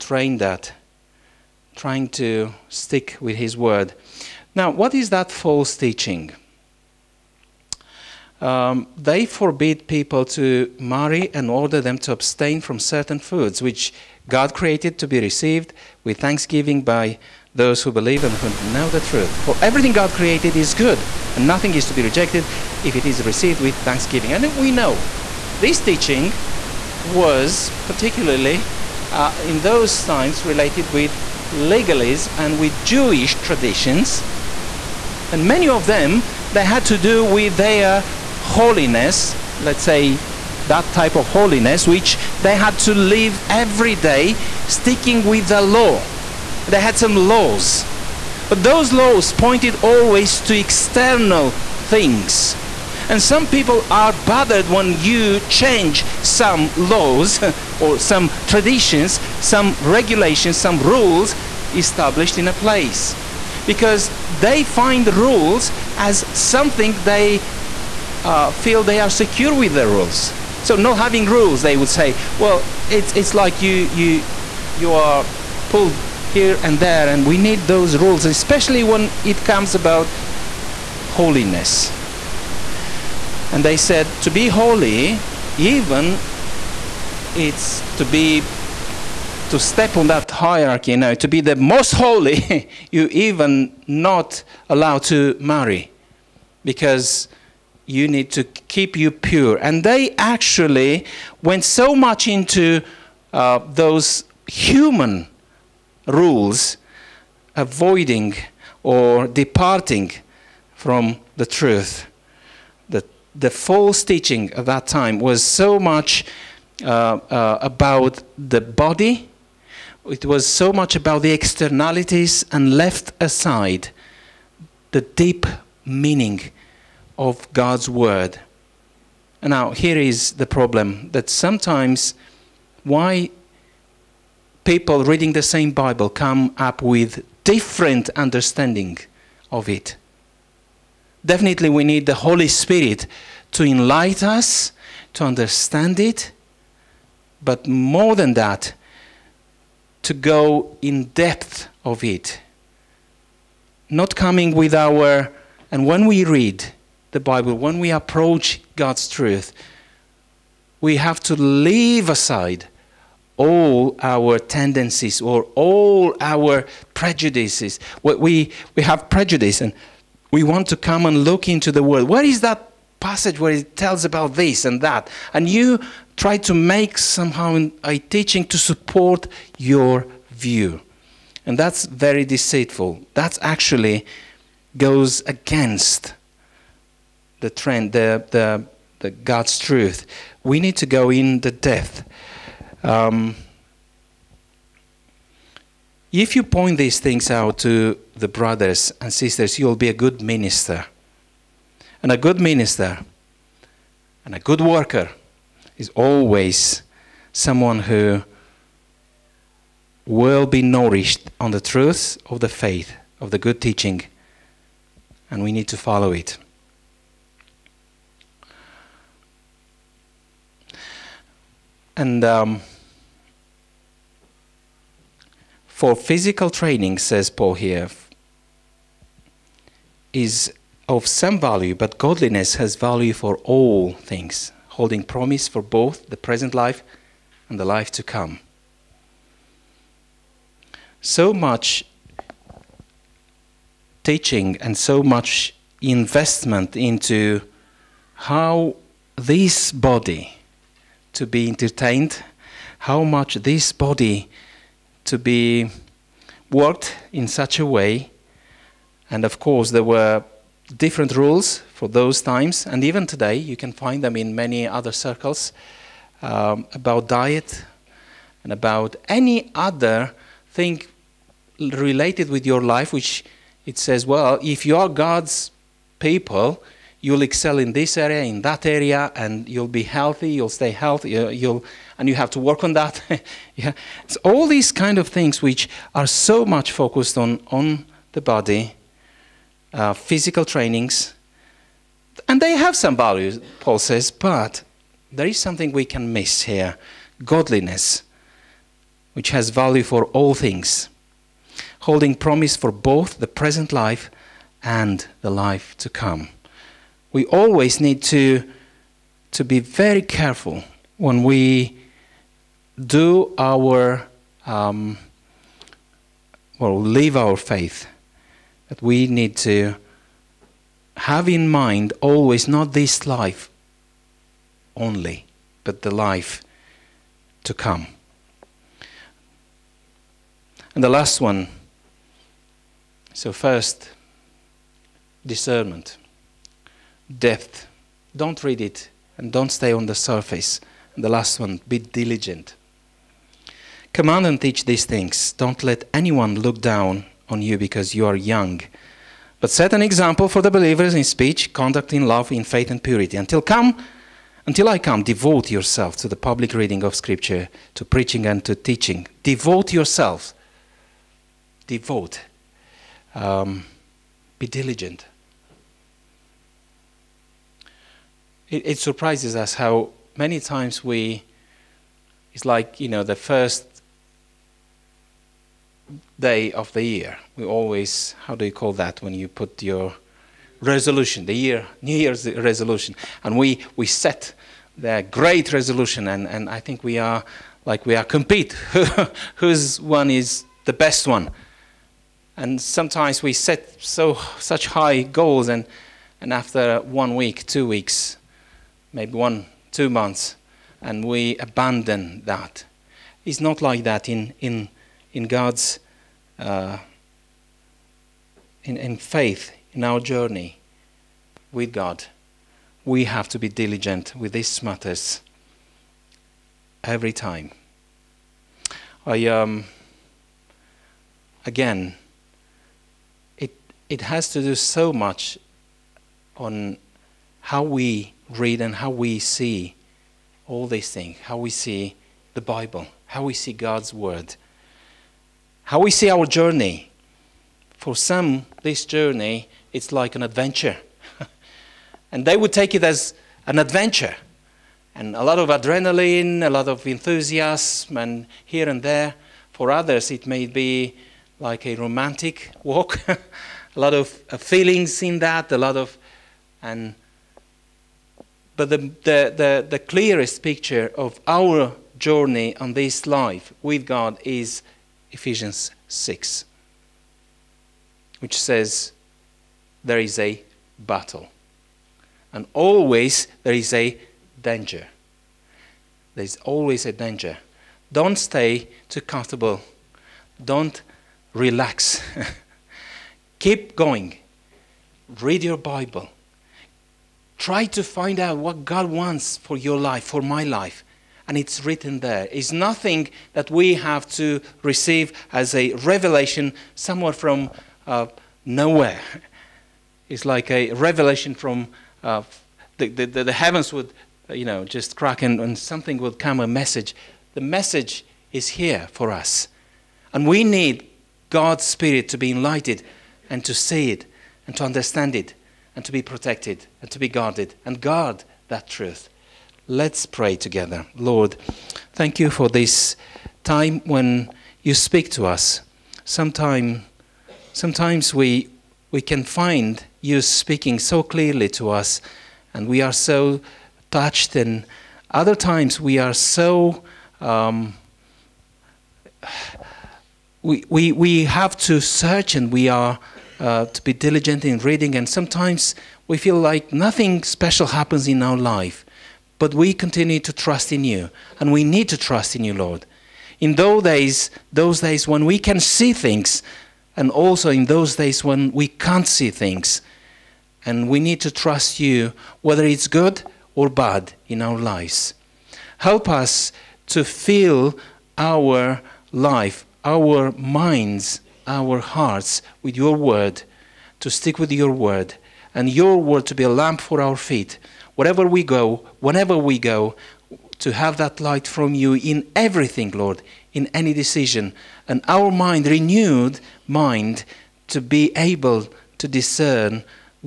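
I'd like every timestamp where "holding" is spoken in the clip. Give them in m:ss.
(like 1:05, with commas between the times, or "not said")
3:54, 5:01.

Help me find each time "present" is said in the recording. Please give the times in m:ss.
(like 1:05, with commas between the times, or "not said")
3:56, 5:03.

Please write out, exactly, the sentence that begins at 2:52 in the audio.
Where is that passage where it tells about this and that?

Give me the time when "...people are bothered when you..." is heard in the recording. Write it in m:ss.
0:53.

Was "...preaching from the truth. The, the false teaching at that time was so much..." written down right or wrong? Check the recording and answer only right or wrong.
wrong.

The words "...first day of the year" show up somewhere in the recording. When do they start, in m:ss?
6:13.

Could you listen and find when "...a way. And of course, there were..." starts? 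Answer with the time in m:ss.
4:17.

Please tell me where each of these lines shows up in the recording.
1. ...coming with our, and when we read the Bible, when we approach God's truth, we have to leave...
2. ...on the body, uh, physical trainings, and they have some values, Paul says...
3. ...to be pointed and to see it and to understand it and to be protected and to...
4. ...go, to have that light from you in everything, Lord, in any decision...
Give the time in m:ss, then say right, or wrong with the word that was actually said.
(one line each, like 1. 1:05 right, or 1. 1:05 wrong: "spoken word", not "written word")
1. 2:34 right
2. 4:47 right
3. 8:32 wrong: "enlightened", not "pointed"
4. 9:39 right.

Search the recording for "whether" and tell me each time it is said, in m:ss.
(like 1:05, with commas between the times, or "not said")
9:22.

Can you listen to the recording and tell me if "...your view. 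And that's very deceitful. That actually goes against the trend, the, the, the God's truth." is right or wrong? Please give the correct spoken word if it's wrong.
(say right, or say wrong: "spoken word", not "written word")
right.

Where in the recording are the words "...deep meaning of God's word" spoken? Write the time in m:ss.
2:05.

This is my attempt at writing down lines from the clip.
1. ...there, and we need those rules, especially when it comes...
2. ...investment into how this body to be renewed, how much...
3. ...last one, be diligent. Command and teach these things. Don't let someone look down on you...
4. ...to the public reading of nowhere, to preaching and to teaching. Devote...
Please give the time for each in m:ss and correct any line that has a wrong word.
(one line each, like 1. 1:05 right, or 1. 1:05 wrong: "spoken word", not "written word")
1. 1:16 right
2. 4:05 wrong: "entertained", not "renewed"
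3. 5:41 wrong: "anyone", not "someone"
4. 5:55 wrong: "scripture", not "nowhere".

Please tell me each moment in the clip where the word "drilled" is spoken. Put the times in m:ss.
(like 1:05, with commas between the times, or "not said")
not said.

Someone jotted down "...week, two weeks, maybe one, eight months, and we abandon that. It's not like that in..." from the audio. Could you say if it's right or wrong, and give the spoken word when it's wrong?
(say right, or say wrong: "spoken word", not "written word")
wrong: "two", not "eight".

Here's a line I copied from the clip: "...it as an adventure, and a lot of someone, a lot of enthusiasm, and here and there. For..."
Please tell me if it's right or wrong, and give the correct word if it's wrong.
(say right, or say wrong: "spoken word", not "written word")
wrong: "adrenaline", not "someone".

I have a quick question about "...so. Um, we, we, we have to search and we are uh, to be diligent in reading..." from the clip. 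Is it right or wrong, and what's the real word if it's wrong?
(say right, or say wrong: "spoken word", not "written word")
right.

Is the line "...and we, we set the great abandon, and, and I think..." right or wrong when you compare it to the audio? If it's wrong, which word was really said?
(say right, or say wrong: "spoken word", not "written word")
wrong: "resolution", not "abandon".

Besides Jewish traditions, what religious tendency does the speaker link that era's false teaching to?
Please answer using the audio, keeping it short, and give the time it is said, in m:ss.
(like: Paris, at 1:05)
legalism, at 0:31.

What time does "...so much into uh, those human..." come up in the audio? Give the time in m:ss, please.
1:41.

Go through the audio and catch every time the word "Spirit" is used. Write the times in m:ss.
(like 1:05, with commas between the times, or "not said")
2:22, 8:31.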